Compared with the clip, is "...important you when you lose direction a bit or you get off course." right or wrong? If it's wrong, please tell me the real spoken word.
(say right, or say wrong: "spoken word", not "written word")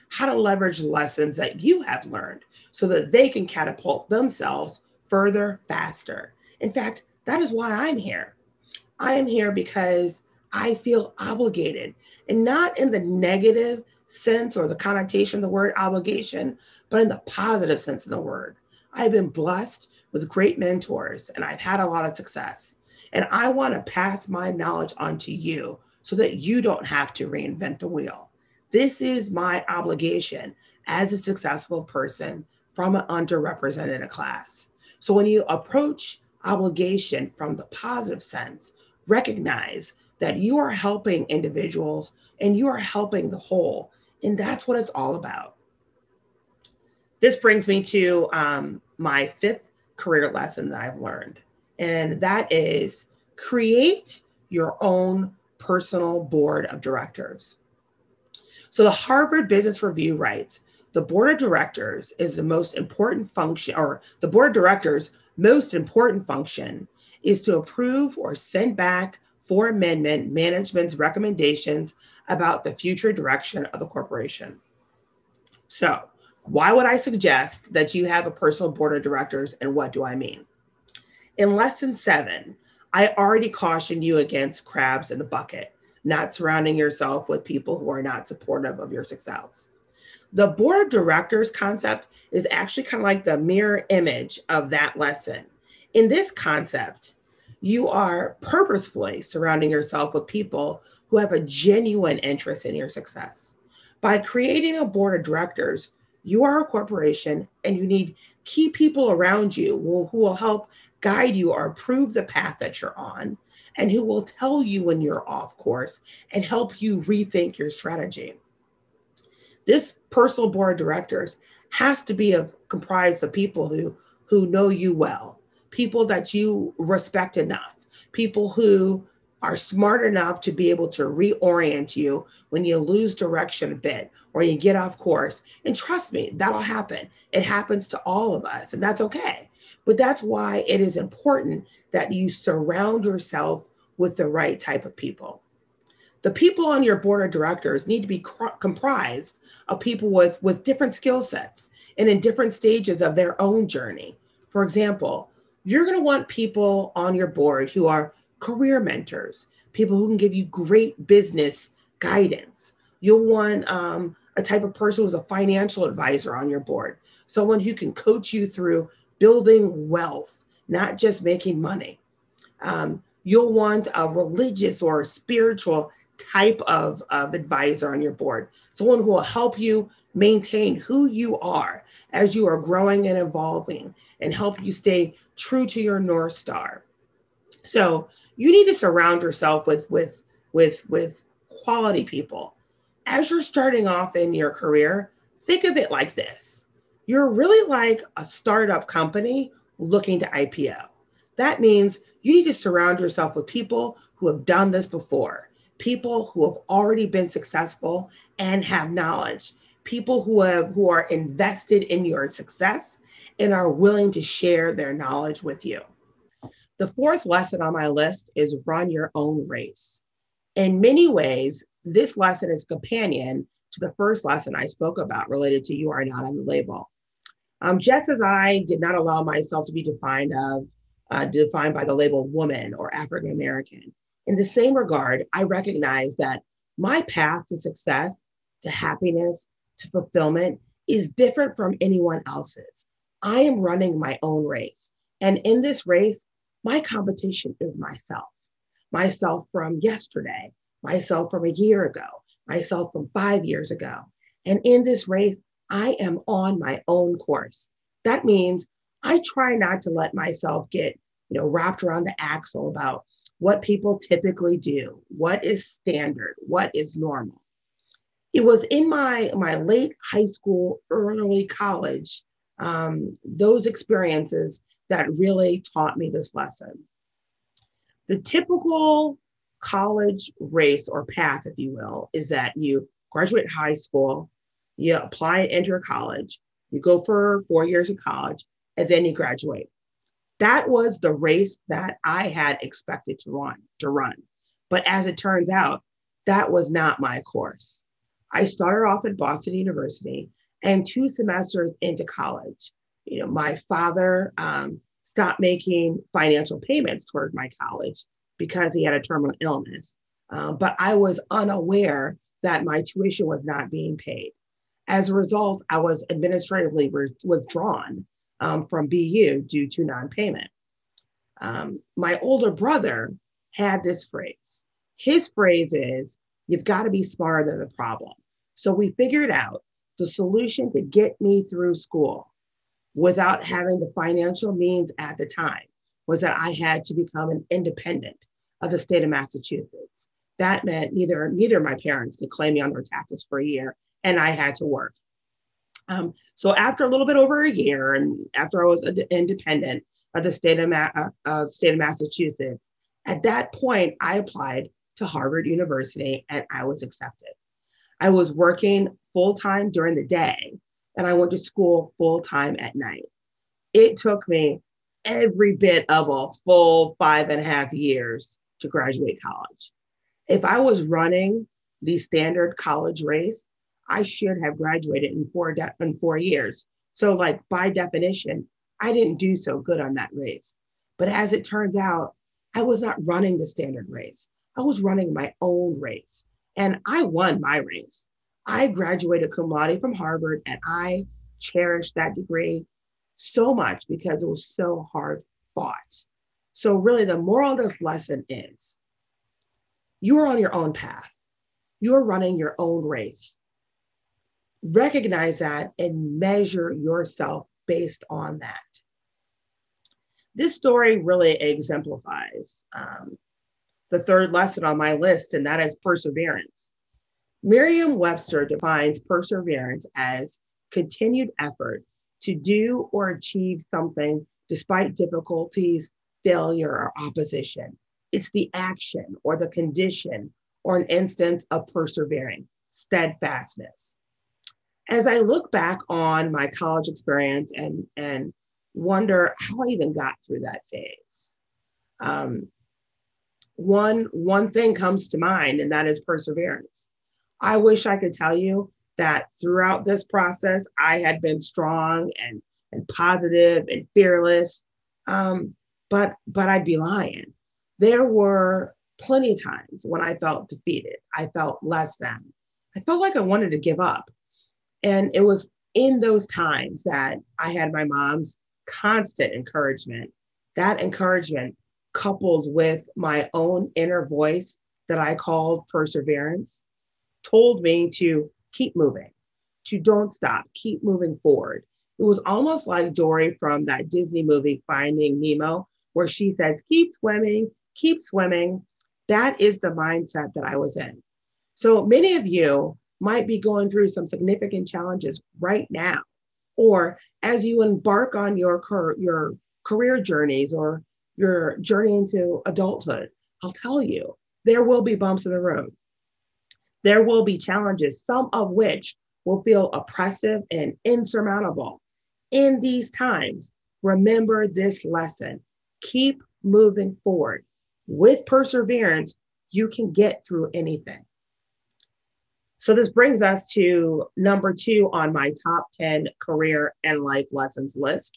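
wrong: "reorient", not "important".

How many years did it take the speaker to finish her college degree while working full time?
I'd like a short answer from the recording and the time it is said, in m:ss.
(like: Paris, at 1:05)
5.5 years, at 6:06.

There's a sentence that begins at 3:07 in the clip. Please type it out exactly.
So you need to surround yourself with, with, with, with quality people.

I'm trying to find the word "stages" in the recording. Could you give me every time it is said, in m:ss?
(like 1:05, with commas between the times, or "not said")
2:32.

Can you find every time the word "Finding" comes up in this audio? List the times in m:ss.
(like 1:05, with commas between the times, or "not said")
8:04.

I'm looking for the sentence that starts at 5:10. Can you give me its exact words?
Uh, but I was unaware that my tuition was not being paid.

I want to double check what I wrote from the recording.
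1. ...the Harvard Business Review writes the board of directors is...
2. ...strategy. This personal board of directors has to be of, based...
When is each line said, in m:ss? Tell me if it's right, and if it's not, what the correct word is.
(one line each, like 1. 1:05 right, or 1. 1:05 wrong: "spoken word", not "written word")
1. 0:58 right
2. 1:57 wrong: "comprised", not "based".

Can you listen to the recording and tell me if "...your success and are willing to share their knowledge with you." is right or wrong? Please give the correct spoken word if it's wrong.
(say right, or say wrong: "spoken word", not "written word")
right.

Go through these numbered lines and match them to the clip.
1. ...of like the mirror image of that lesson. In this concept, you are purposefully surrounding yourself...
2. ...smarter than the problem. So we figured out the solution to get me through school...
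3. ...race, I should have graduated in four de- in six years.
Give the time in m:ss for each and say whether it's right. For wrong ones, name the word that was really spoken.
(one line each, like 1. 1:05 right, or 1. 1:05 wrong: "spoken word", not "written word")
1. 1:33 right
2. 5:27 right
3. 6:13 wrong: "four", not "six".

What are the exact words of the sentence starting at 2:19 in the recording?
But that's why it is important that you surround yourself with the right type of people.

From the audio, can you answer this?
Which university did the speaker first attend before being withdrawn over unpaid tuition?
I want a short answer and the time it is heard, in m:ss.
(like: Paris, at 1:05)
Boston University, at 4:59.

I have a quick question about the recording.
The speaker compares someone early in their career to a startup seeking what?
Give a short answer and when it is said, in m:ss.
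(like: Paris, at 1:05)
IPO, at 3:20.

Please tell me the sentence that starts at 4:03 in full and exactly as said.
I am running my own race.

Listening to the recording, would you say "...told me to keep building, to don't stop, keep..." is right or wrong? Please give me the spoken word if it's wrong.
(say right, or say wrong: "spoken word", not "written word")
wrong: "moving", not "building".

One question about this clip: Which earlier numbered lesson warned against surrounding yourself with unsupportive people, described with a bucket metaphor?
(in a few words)
Lesson 7.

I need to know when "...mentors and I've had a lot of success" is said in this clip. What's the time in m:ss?
0:20.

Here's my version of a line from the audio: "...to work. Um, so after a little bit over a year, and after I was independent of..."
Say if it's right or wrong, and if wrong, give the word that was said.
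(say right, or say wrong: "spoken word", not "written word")
right.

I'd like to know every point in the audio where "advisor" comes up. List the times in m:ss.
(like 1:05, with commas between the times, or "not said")
2:45, 2:57.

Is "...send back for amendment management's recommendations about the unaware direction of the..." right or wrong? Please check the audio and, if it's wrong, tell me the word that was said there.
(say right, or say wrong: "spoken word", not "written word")
wrong: "future", not "unaware".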